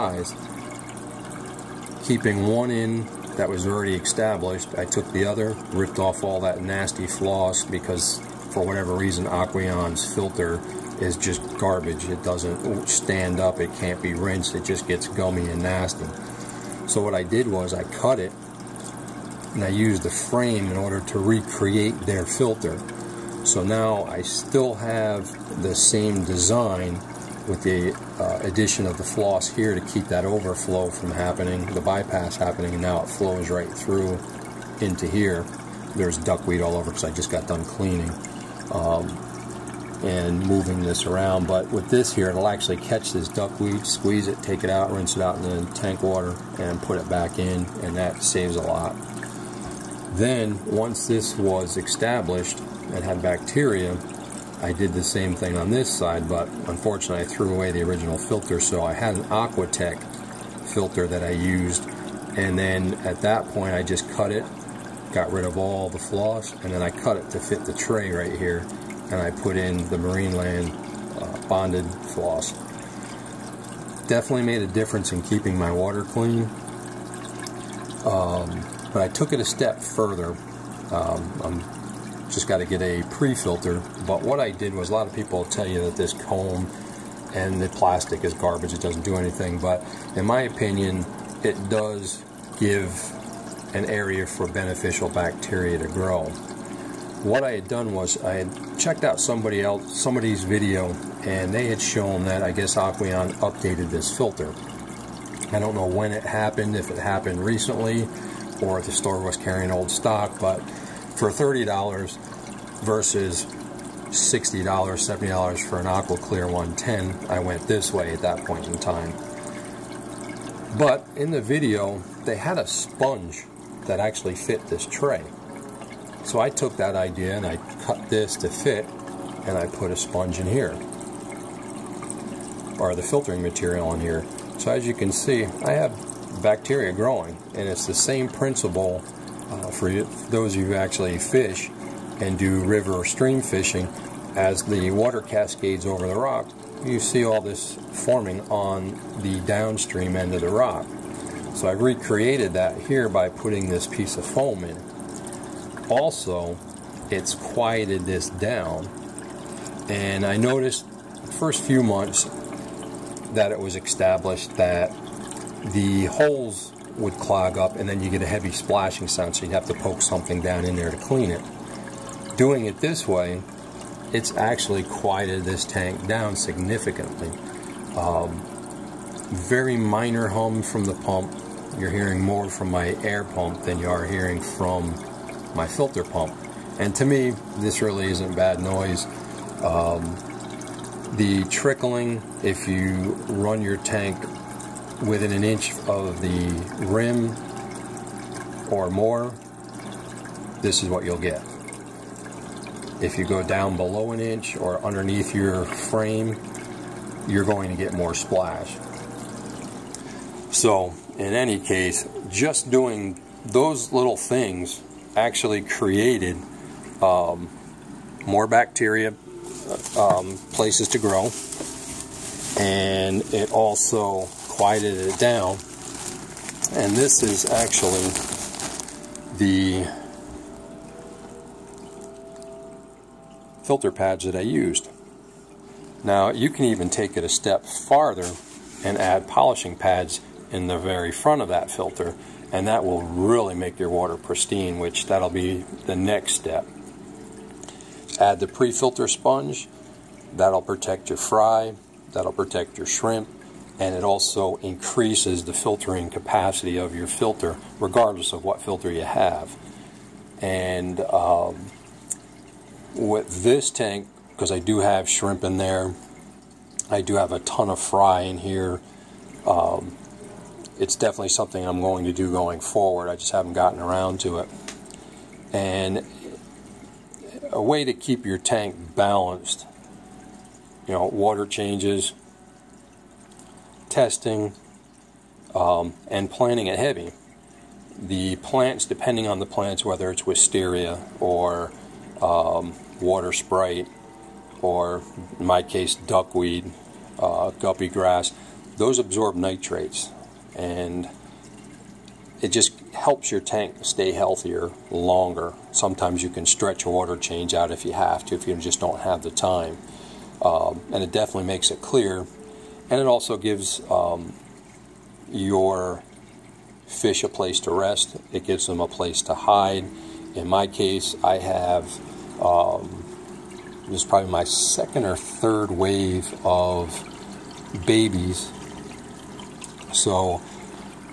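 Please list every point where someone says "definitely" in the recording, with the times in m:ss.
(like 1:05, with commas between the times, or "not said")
1:14, 4:30, 5:11.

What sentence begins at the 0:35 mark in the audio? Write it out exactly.
There's duckweed all over because I just got done cleaning um, and moving this around.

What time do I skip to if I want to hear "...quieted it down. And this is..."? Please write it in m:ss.
3:44.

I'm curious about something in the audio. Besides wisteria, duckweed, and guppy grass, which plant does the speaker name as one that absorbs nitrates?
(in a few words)
water sprite.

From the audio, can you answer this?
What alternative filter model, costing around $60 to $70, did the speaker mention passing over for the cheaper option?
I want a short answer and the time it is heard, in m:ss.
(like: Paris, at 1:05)
Aqua Clear 110, at 1:55.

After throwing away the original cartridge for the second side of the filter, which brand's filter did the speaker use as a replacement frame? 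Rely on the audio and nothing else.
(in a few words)
Aquatech.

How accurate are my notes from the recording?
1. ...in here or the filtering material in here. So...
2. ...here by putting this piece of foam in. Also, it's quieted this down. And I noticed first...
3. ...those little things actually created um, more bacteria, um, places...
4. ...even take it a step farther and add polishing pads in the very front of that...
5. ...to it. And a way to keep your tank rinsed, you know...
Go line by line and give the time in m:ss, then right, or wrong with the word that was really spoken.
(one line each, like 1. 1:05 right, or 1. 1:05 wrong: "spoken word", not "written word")
1. 2:10 right
2. 2:32 right
3. 3:33 right
4. 3:56 right
5. 4:34 wrong: "balanced", not "rinsed".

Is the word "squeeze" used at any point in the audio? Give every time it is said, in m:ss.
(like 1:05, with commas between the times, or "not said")
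0:43.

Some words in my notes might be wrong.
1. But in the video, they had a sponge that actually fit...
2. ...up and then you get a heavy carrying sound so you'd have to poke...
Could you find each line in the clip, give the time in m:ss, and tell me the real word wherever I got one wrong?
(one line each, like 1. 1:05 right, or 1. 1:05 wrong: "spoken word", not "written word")
1. 2:00 right
2. 2:47 wrong: "splashing", not "carrying".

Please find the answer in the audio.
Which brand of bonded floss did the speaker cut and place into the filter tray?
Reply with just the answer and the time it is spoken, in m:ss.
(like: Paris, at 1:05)
Marineland, at 1:09.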